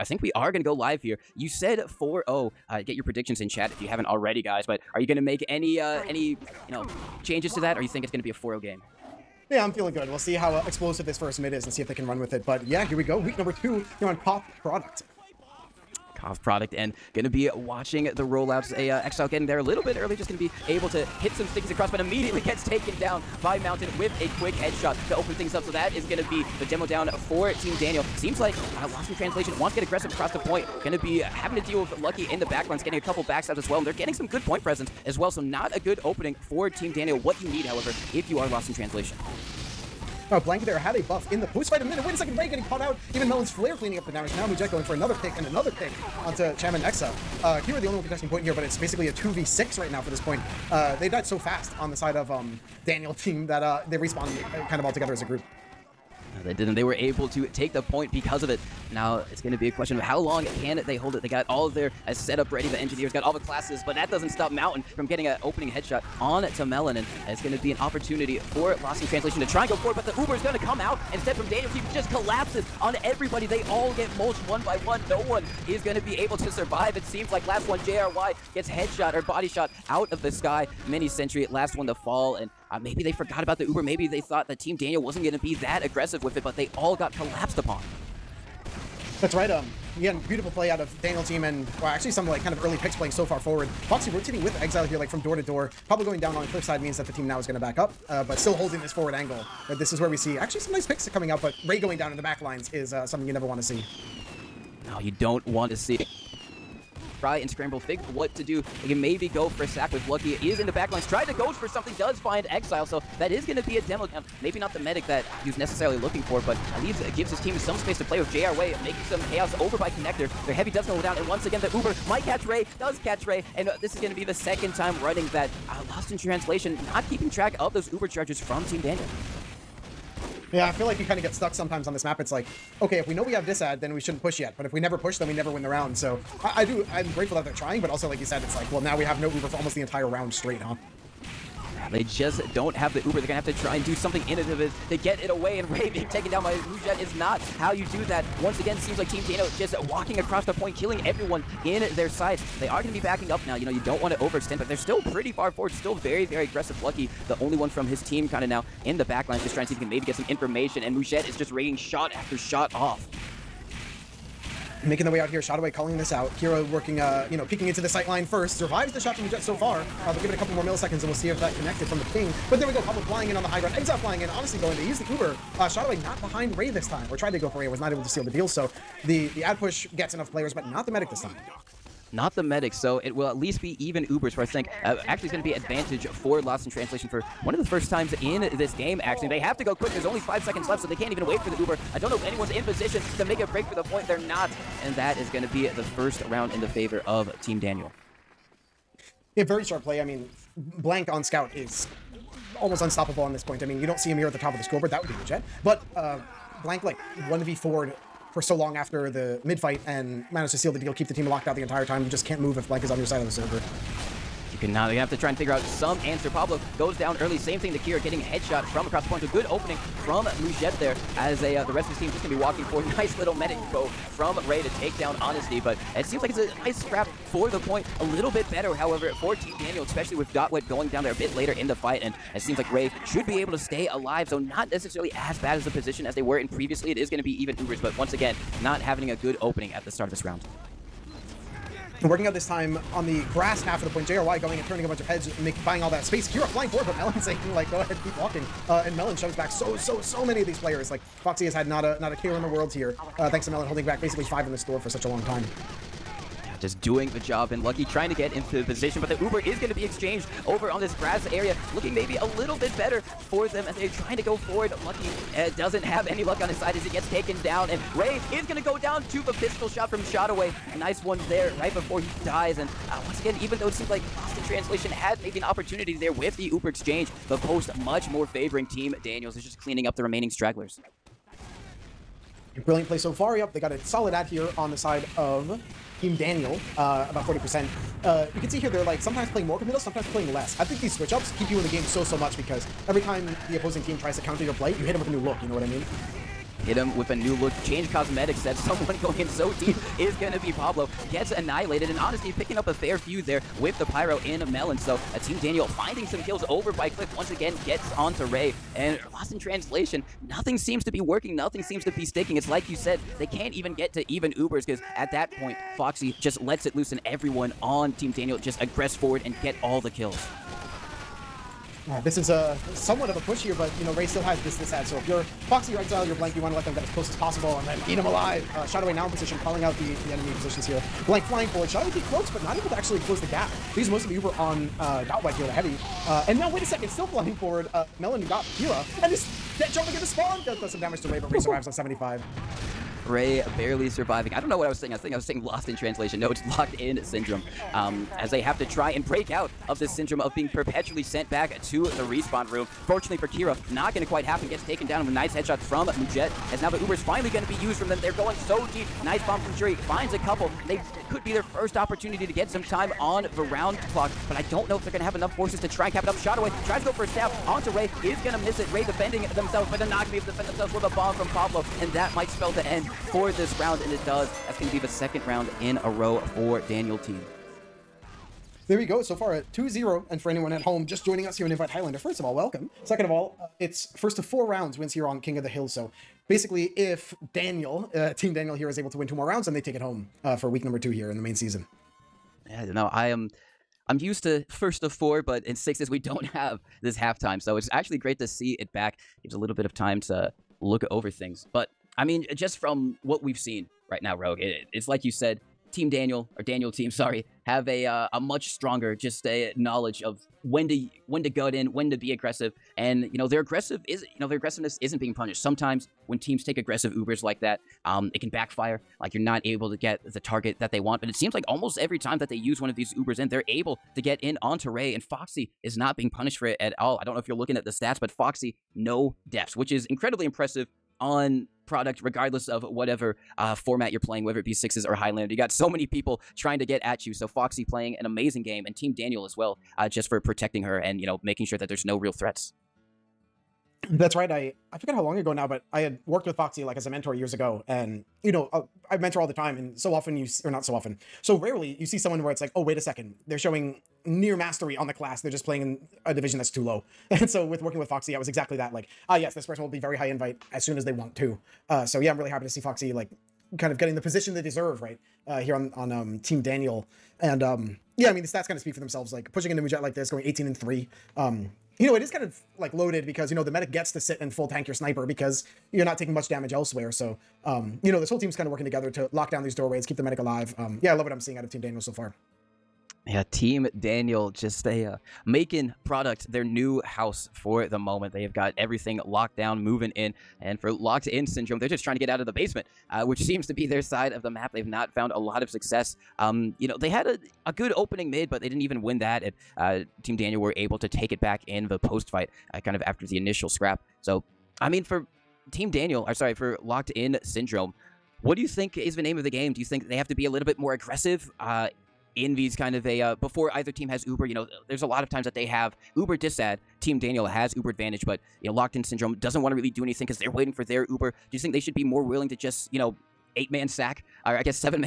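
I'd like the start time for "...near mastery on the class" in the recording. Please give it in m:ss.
7:34.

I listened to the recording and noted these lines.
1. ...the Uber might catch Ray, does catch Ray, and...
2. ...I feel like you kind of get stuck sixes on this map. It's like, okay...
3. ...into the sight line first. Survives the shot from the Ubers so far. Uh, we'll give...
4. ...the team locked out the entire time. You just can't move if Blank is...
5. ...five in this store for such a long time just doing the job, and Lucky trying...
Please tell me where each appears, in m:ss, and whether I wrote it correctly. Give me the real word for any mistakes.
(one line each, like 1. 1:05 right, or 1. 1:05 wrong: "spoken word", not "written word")
1. 2:01 right
2. 2:10 wrong: "sometimes", not "sixes"
3. 2:47 wrong: "Jet", not "Ubers"
4. 3:31 right
5. 4:14 right.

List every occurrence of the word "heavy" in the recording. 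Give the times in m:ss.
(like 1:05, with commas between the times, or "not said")
2:00, 5:35.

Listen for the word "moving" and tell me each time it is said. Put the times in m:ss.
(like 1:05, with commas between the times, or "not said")
8:09.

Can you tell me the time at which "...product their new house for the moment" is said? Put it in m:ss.
8:05.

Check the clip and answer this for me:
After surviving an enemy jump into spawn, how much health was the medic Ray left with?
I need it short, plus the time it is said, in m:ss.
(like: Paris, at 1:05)
75, at 5:41.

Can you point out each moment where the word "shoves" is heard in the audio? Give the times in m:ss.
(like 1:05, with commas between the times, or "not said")
4:09.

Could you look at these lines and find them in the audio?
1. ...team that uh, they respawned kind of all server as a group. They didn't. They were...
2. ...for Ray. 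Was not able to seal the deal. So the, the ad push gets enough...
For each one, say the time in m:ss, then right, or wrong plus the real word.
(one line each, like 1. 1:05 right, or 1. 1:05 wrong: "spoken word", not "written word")
1. 0:53 wrong: "together", not "server"
2. 2:57 right.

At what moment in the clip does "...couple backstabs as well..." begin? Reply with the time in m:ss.
0:33.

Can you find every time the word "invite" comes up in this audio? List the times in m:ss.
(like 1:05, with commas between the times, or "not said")
6:21, 7:40.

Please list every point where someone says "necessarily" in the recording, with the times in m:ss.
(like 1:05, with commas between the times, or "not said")
1:55, 3:54.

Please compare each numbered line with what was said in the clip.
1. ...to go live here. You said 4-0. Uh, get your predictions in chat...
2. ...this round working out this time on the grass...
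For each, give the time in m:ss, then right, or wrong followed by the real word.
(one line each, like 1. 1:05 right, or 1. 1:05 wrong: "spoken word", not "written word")
1. 0:00 right
2. 4:00 right.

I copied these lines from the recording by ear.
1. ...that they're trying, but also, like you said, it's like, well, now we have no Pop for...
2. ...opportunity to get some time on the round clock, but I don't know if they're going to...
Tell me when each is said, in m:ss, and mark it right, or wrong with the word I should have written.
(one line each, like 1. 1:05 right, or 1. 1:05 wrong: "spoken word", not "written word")
1. 2:17 wrong: "Uber", not "Pop"
2. 6:01 right.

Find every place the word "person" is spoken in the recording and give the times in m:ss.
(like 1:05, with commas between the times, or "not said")
7:39.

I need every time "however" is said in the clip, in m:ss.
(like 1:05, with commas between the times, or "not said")
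0:37, 3:48.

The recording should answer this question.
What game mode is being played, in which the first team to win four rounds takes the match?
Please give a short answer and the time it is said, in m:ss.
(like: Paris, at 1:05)
King of the Hill, at 6:25.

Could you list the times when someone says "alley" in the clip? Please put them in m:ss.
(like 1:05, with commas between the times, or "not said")
not said.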